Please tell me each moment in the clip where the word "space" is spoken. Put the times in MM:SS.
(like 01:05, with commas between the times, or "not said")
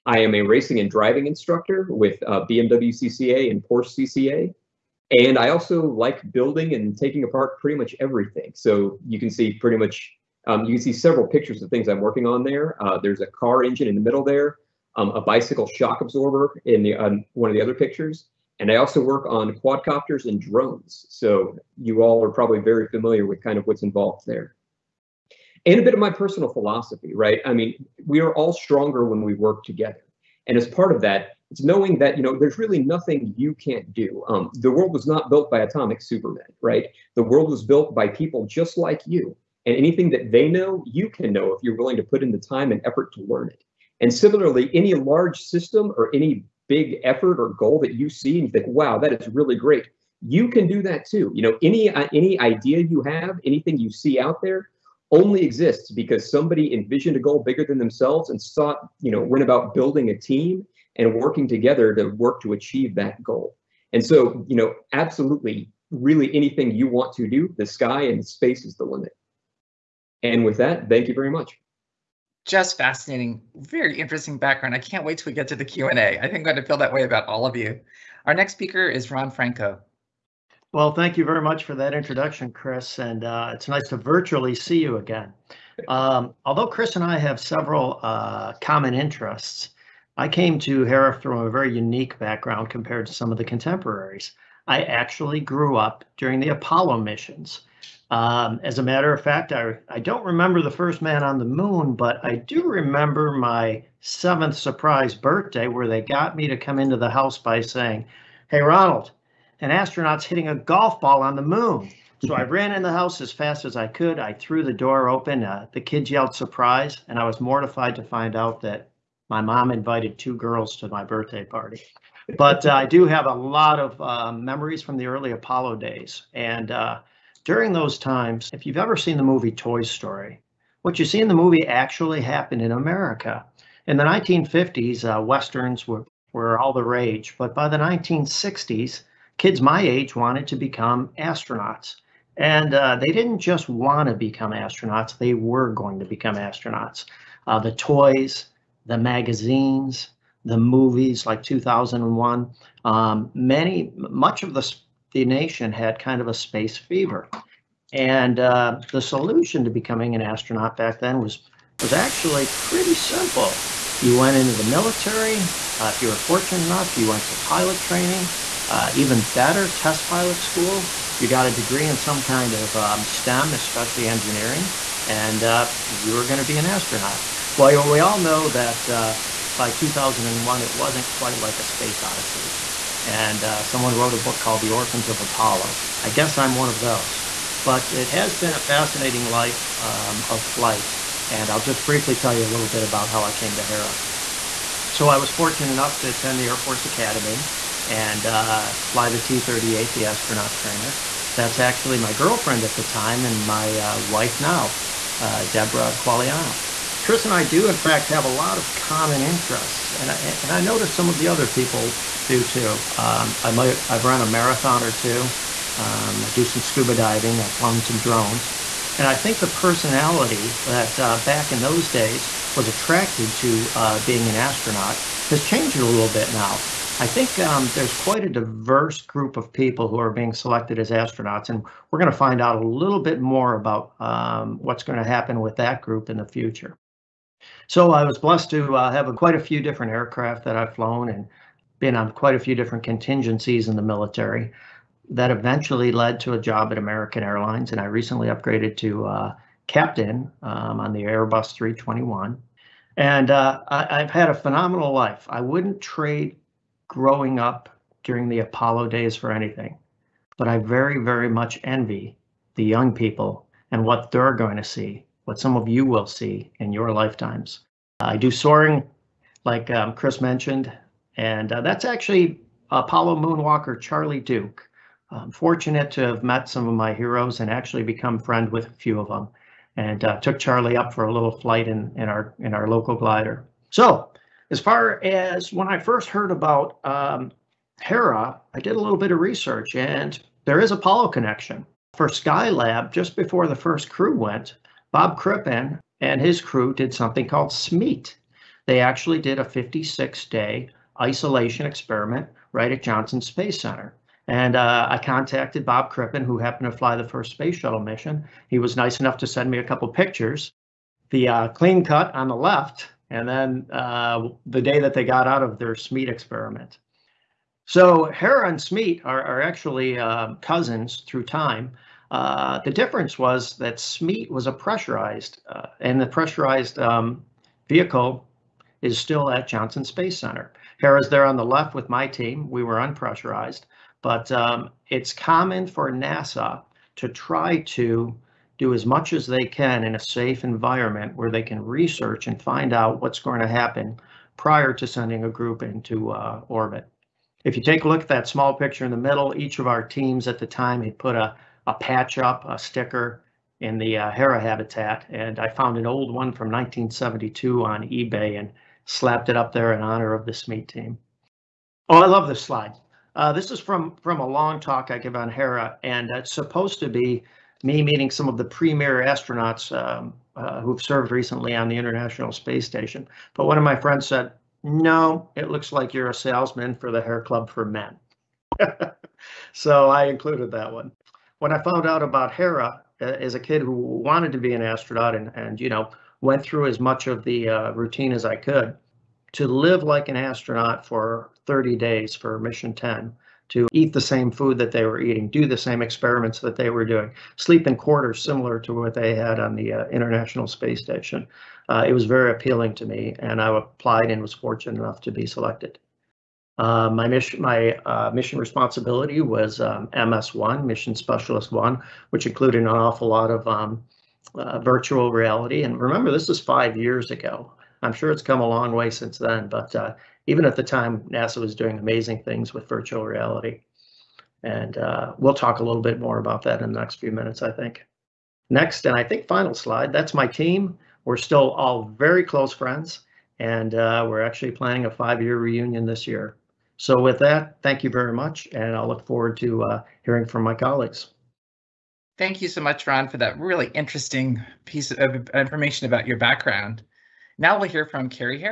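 01:08, 02:36, 03:01, 05:03, 05:07, 05:29, 06:12, 06:40.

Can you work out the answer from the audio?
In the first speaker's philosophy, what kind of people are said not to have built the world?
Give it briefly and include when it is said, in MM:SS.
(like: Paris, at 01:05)
atomic supermen, at 00:35.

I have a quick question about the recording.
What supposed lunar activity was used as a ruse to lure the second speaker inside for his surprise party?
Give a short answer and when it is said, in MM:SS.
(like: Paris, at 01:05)
hitting a golf ball, at 01:50.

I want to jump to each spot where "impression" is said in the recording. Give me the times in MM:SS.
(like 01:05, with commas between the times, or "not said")
not said.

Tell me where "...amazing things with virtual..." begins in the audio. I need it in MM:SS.
07:01.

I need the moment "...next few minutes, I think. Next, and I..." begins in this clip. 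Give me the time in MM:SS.
07:06.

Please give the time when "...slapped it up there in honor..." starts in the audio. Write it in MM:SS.
05:58.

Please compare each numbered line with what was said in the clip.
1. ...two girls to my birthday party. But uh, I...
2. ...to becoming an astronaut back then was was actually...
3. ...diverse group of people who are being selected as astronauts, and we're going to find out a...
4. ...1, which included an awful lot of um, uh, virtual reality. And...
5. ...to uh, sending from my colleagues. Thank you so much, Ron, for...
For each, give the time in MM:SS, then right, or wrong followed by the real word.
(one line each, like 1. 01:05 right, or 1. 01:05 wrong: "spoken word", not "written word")
1. 02:00 right
2. 02:39 right
3. 03:48 right
4. 06:51 right
5. 07:19 wrong: "hearing", not "sending".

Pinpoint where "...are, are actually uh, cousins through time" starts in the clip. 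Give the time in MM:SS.
05:19.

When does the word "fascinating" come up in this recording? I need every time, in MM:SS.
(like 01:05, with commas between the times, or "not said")
01:12, 03:08.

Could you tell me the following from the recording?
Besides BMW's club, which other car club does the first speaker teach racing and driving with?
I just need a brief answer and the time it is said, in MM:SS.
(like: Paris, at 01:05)
Porsche CCA, at 00:03.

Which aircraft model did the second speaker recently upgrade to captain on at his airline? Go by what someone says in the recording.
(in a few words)
Airbus 321.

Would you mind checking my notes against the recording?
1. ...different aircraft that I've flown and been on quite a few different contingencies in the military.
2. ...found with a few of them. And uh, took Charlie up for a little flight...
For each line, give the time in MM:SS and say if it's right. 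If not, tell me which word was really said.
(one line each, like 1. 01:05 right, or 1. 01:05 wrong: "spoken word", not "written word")
1. 03:59 right
2. 04:38 wrong: "friend", not "found".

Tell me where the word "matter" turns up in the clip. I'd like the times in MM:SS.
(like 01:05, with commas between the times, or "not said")
01:38.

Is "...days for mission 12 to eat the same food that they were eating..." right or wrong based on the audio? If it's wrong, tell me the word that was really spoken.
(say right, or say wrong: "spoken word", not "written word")
wrong: "10", not "12".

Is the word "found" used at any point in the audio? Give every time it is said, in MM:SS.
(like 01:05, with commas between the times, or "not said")
05:55, 06:21.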